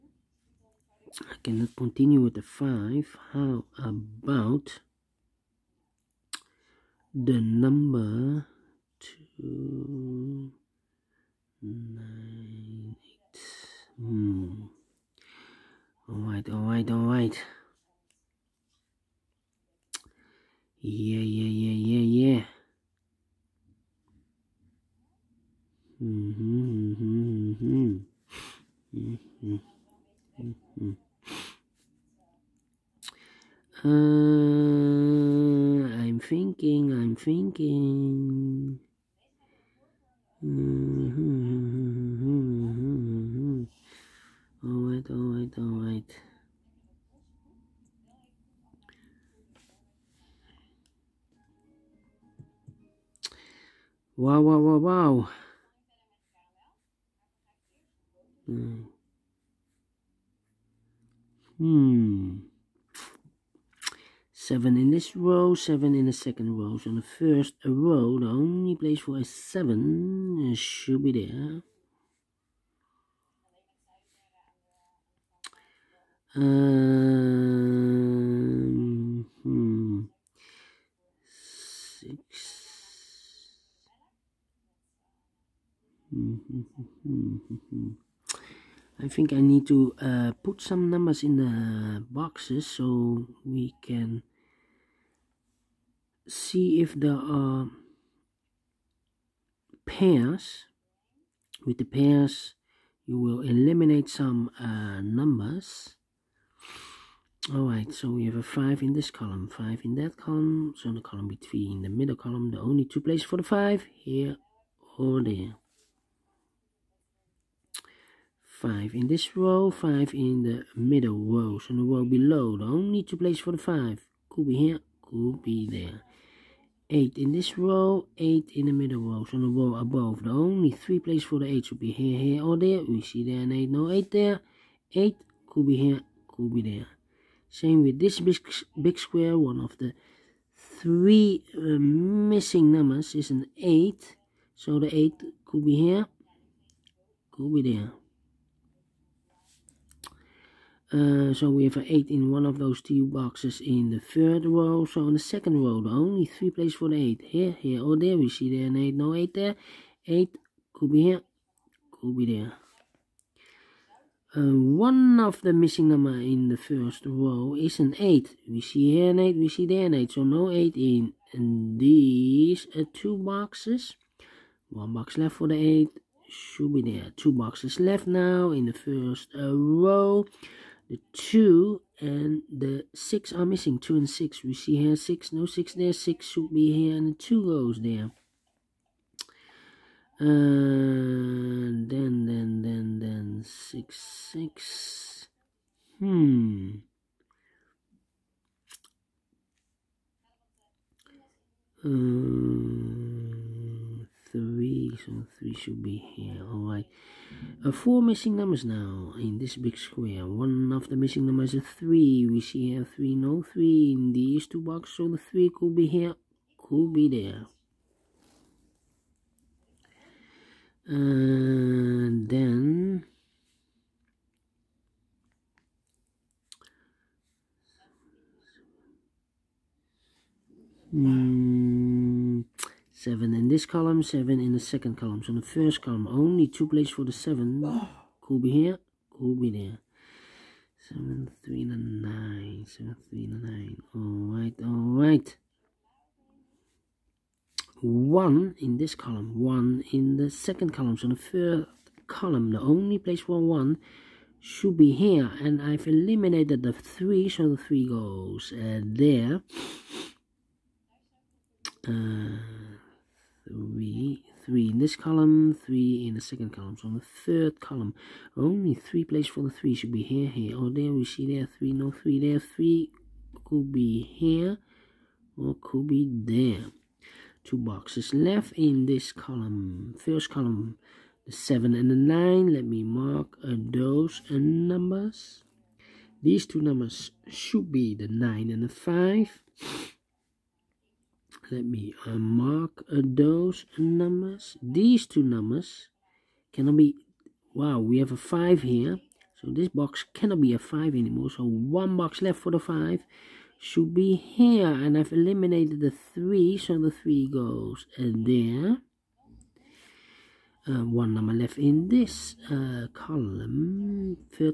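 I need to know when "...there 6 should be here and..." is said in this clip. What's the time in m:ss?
3:05.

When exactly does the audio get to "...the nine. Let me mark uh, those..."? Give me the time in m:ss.
4:41.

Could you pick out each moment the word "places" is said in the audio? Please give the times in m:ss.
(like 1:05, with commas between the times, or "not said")
1:08, 1:53, 2:03, 2:10, 2:36, 3:56, 4:12, 4:29.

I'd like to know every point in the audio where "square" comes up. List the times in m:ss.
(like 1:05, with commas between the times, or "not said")
2:18, 3:29.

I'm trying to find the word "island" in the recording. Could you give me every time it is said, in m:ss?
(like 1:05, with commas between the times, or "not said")
not said.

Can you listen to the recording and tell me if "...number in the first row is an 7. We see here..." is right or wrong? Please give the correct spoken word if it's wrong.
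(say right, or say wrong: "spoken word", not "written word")
wrong: "8", not "7".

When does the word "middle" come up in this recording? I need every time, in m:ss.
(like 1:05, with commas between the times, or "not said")
1:51, 2:00, 2:08.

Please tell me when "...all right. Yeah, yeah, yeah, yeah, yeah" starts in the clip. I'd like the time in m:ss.
0:16.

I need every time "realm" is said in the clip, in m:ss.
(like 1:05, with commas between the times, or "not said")
not said.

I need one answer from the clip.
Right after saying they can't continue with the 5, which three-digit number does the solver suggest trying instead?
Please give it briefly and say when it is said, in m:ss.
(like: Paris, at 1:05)
298, at 0:08.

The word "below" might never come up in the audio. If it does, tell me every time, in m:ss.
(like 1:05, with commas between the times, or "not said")
2:02.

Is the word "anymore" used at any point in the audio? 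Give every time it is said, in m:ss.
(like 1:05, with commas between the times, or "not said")
5:00.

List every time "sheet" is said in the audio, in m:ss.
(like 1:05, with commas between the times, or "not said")
not said.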